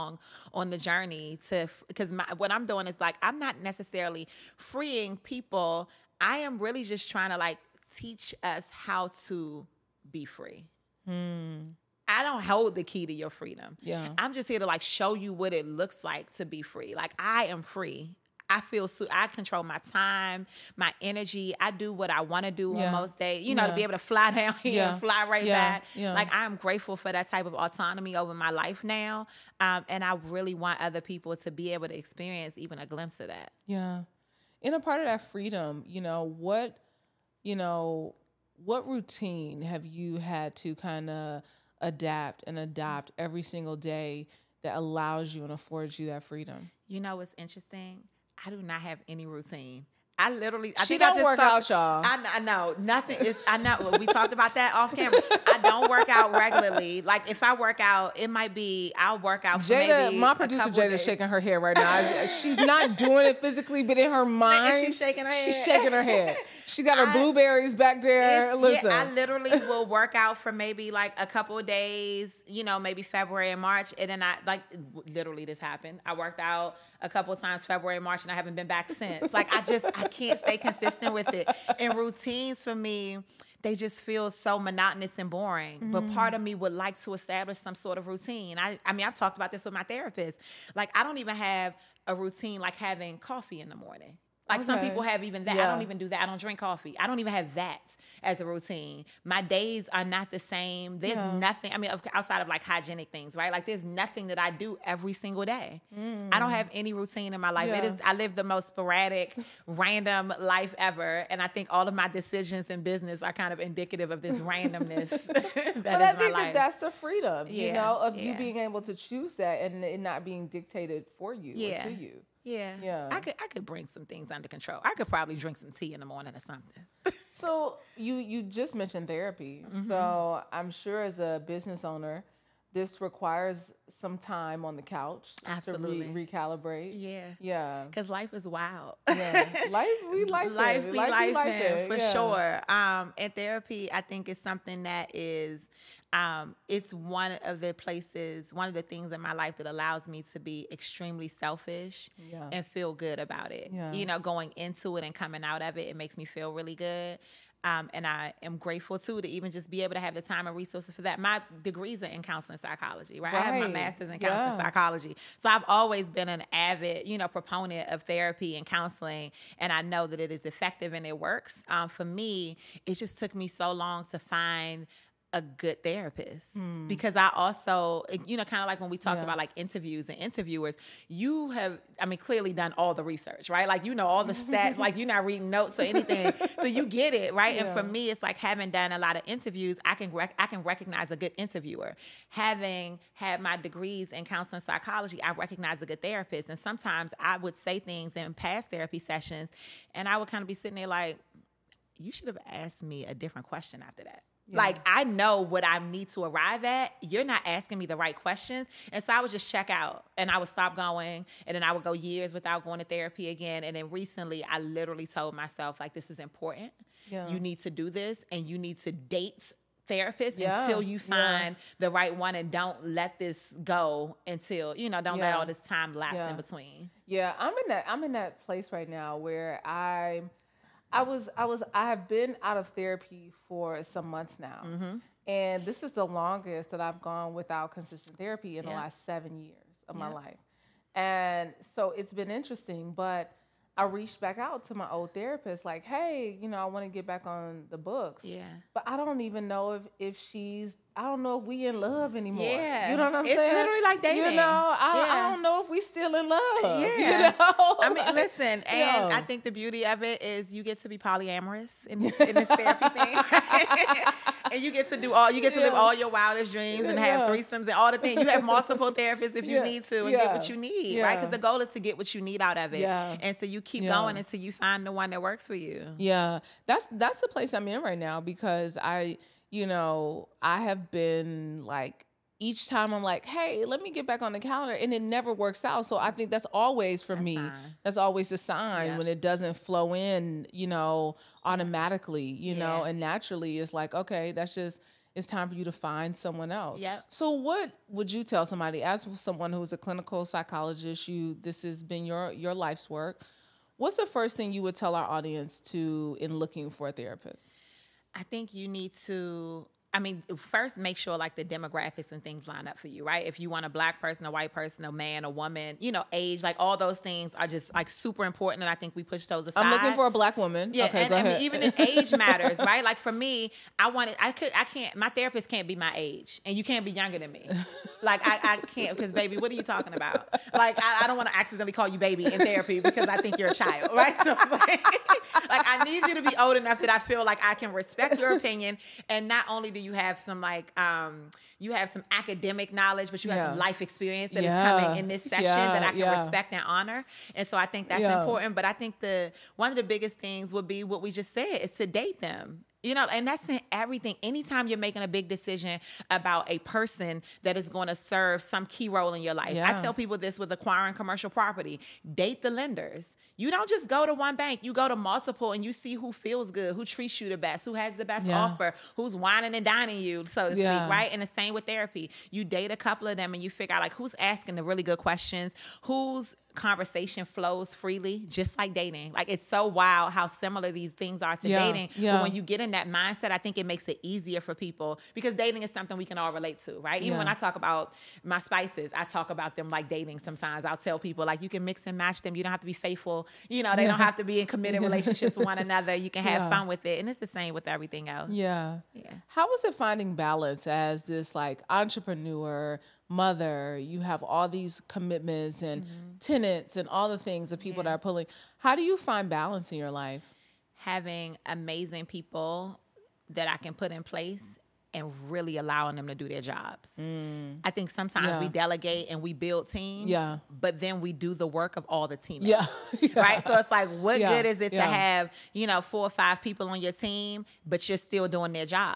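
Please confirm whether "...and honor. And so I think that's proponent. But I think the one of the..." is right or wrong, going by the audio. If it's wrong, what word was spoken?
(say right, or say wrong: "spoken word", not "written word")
wrong: "important", not "proponent".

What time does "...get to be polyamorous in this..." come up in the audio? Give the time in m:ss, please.
4:20.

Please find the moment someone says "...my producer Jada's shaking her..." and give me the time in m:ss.
1:00.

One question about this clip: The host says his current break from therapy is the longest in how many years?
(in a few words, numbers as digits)
7.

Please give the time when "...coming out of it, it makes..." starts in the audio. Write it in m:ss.
2:35.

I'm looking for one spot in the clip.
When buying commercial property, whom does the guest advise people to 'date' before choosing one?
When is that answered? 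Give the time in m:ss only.
6:02.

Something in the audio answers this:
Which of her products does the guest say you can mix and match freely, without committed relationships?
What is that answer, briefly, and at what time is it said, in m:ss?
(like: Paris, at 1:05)
Spices, at 6:28.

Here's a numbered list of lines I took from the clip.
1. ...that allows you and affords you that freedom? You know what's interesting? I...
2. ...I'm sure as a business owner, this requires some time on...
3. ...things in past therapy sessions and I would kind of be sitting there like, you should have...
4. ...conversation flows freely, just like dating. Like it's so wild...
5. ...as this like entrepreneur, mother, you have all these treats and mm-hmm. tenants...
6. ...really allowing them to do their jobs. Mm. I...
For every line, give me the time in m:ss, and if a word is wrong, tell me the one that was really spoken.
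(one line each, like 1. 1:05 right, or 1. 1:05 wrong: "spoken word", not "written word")
1. 0:44 right
2. 2:10 right
3. 3:17 right
4. 6:16 right
5. 6:40 wrong: "commitments", not "treats"
6. 6:55 right.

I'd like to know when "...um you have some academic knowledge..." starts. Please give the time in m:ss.
5:40.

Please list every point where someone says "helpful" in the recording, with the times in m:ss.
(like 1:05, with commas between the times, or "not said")
not said.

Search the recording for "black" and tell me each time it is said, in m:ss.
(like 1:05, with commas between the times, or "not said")
5:13, 5:20.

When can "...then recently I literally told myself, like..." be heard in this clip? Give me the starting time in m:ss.
3:33.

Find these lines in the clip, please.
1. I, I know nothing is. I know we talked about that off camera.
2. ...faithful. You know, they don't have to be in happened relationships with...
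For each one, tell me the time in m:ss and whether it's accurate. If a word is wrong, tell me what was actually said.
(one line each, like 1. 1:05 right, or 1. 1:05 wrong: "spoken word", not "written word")
1. 0:52 right
2. 6:32 wrong: "committed", not "happened".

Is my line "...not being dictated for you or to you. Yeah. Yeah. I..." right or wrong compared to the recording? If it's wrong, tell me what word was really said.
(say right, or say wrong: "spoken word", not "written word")
right.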